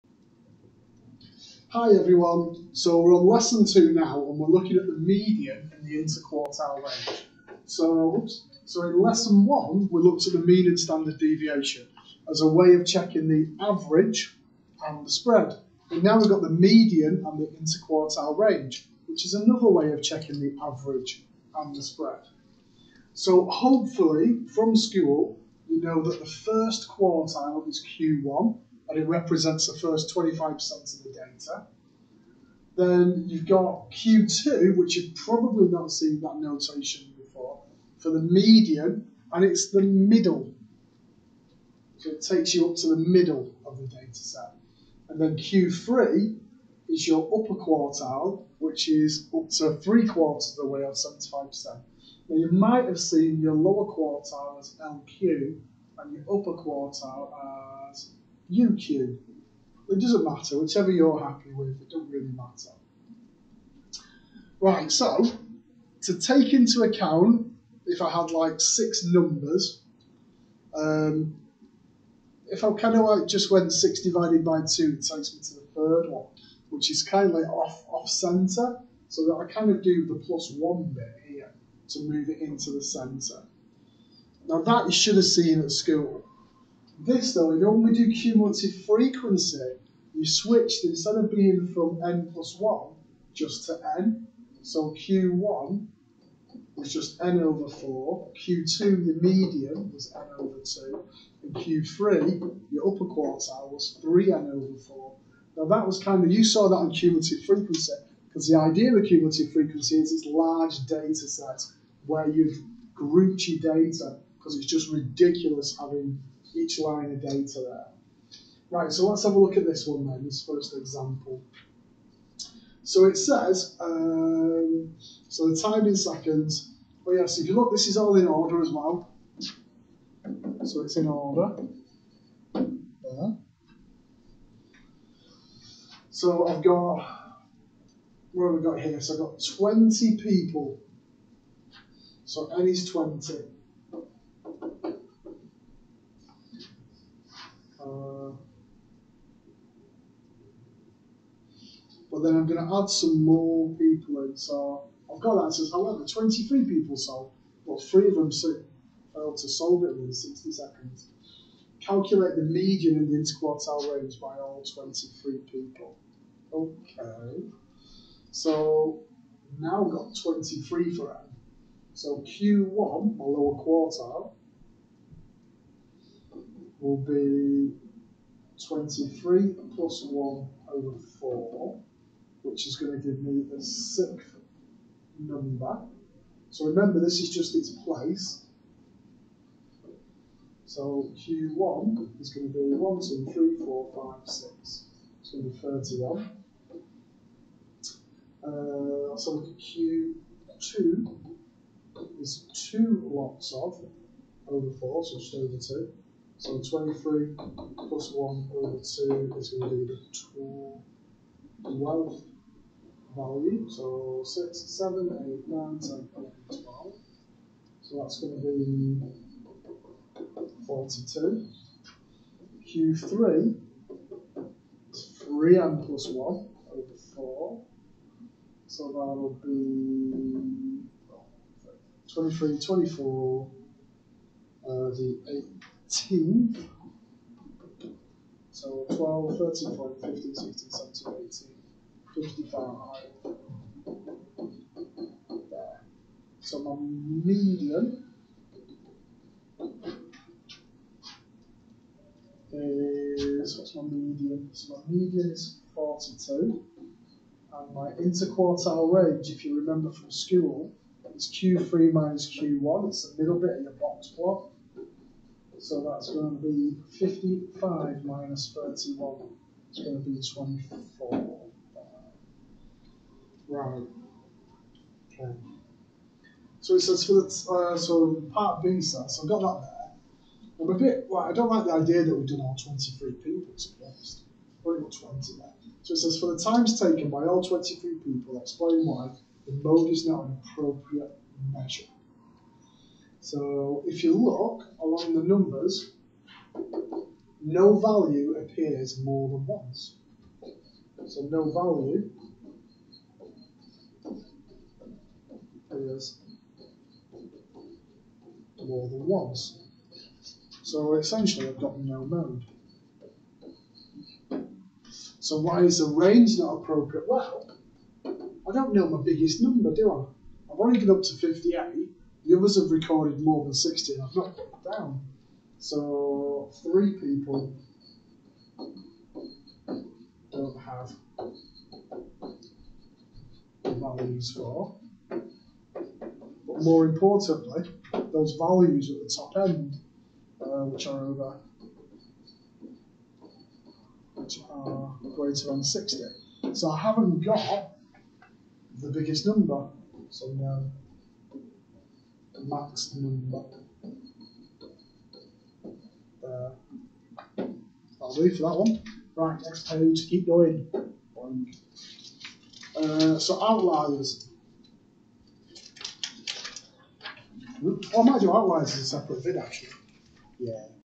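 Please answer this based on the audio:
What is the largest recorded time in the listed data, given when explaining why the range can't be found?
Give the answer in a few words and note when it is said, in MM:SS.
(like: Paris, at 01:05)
58, at 05:20.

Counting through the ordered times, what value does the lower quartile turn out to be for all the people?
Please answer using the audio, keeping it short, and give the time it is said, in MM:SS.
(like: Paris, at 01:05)
31, at 03:15.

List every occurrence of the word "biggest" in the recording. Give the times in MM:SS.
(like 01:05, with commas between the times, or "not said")
05:19, 05:48.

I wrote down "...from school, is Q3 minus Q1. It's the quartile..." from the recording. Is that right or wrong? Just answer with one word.
wrong.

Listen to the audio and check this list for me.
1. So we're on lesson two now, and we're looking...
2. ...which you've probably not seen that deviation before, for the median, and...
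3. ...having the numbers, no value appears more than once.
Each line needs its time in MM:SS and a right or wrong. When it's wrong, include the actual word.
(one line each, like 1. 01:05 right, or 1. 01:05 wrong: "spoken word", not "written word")
1. 00:02 right
2. 00:34 wrong: "notation", not "deviation"
3. 04:54 wrong: "along", not "having".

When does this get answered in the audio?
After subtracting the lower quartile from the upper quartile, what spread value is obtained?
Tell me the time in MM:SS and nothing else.
04:29.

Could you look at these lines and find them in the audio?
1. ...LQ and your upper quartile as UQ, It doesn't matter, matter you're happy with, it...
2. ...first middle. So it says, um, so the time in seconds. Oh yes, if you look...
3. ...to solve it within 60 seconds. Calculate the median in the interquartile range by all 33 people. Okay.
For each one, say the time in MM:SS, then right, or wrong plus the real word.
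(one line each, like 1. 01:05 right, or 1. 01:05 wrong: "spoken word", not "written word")
1. 00:54 wrong: "whichever", not "matter"
2. 02:00 wrong: "example", not "middle"
3. 02:39 wrong: "23", not "33".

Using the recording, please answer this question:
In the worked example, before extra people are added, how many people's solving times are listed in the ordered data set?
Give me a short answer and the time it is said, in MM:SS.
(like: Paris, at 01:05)
20, at 02:19.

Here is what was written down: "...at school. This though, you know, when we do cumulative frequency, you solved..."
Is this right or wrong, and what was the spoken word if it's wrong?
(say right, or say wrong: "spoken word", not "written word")
wrong: "switched", not "solved".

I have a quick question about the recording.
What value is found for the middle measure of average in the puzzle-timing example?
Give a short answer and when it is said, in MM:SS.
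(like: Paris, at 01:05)
42, at 04:14.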